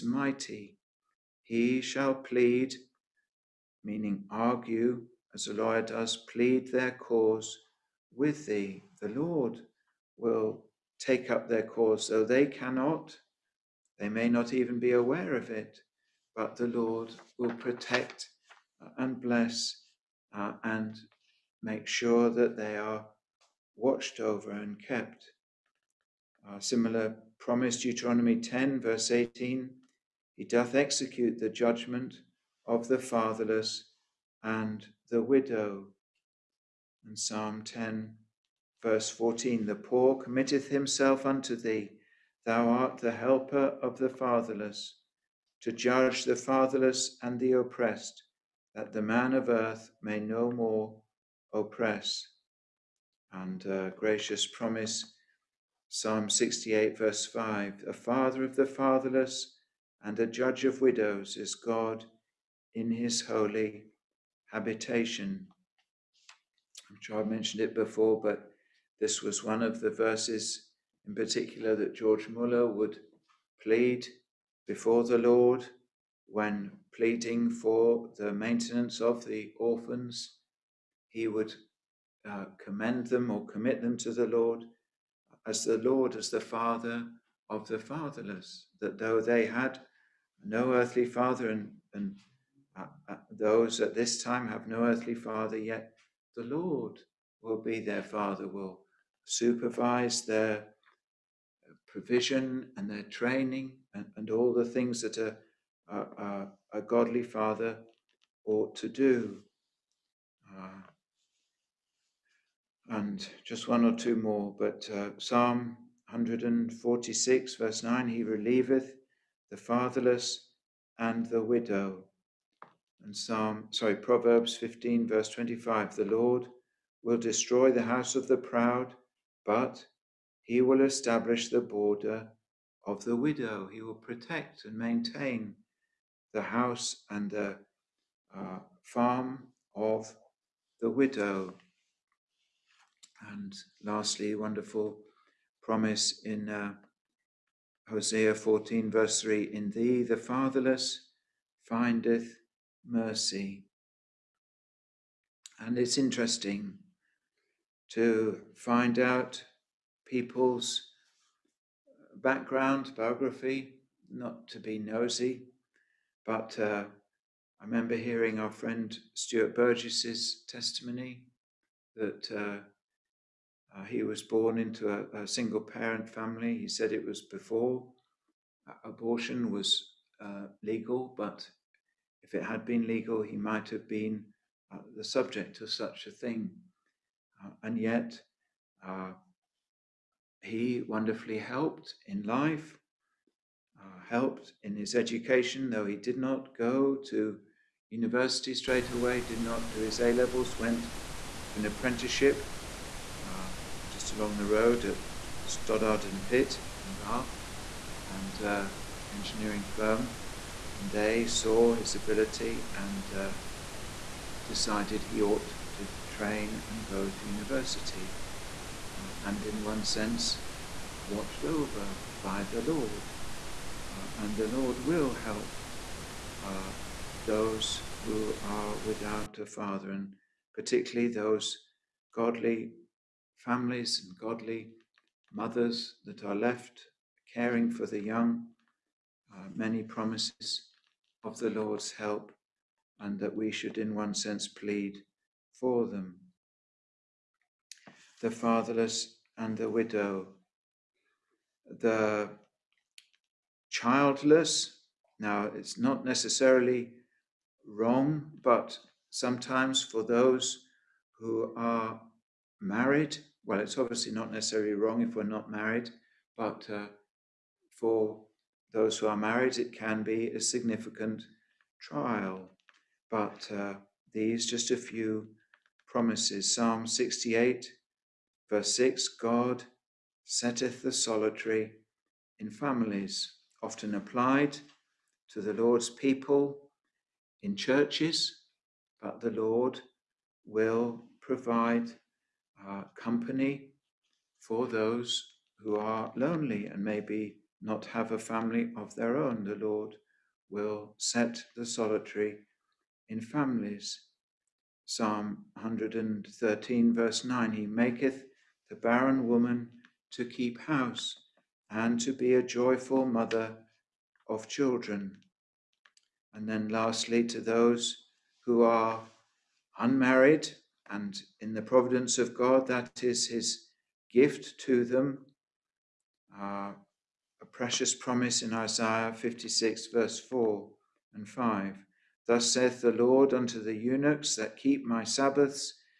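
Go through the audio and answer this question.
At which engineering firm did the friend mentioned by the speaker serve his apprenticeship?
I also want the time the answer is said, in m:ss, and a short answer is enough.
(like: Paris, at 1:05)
Stothert and Pitt, at 3:25.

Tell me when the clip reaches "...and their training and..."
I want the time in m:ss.
1:42.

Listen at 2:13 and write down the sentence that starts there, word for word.
He will protect and maintain the house and the uh, farm of the widow.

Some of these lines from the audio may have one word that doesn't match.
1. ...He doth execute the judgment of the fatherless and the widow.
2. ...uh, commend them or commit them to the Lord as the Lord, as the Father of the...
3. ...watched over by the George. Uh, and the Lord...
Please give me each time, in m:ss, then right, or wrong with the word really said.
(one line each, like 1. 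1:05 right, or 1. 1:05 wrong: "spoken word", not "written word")
1. 0:30 right
2. 1:22 right
3. 3:41 wrong: "Lord", not "George".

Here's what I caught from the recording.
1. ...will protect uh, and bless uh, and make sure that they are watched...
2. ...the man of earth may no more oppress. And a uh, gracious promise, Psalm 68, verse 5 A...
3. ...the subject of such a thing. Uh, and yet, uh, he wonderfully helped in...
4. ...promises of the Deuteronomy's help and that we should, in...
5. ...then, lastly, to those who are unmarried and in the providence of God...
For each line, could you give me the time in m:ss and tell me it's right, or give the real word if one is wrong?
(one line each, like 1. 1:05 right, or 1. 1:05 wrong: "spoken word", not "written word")
1. 0:17 right
2. 0:48 right
3. 3:04 right
4. 3:59 wrong: "Lord", not "Deuteronomy"
5. 5:16 right.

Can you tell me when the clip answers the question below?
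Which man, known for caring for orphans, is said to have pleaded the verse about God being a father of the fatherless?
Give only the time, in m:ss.
1:11.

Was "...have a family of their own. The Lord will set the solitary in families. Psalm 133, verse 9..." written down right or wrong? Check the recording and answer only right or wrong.
wrong.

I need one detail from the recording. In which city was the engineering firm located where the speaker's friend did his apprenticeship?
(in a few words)
Bath.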